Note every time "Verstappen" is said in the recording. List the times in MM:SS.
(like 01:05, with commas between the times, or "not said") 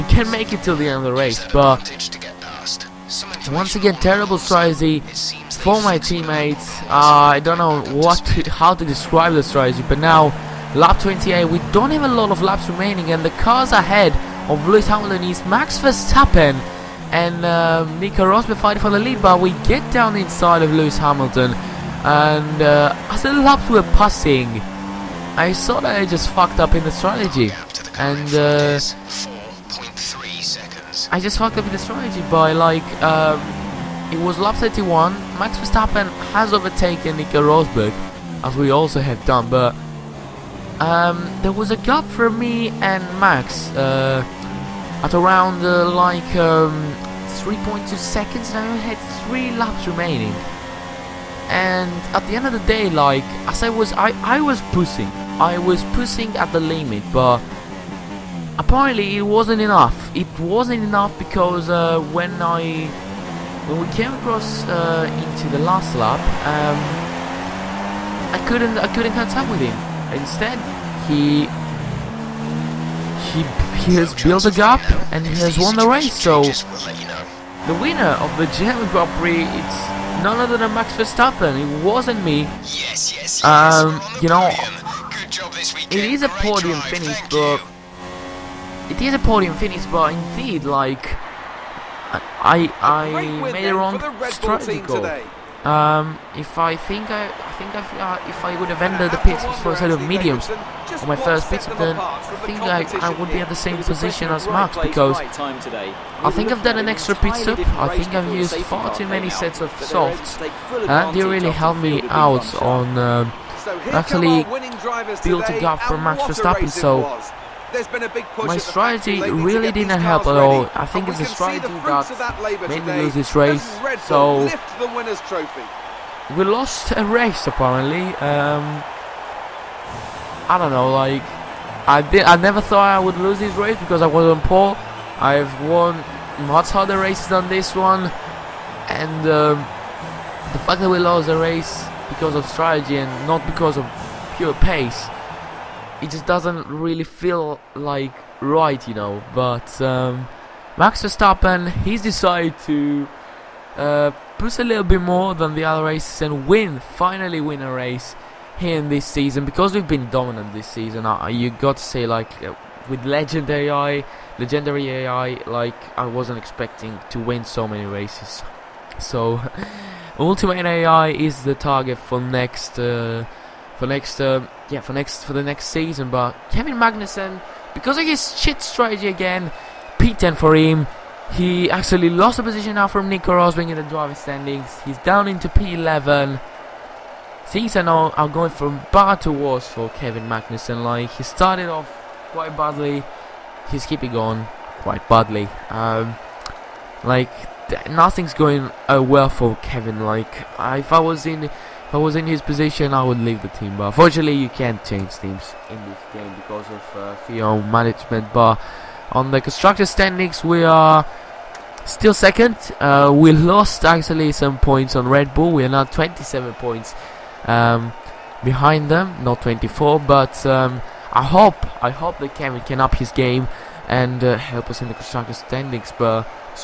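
00:15, 00:35, 01:20, 01:56, 02:31.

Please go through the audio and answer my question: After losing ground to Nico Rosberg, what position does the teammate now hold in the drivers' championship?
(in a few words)
P11.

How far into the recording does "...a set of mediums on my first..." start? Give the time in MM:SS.
01:39.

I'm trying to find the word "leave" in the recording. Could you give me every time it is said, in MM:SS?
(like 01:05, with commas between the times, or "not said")
03:23.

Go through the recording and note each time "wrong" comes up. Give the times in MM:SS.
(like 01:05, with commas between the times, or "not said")
01:33.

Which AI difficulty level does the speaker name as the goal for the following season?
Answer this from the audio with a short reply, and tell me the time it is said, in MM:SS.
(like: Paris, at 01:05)
Ultimate AI, at 02:50.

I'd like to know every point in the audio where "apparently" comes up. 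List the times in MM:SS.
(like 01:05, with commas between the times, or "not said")
00:58, 02:07.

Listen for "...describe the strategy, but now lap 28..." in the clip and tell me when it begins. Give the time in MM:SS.
00:08.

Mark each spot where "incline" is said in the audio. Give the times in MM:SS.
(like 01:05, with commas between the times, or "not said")
not said.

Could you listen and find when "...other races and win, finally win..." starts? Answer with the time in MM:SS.
02:35.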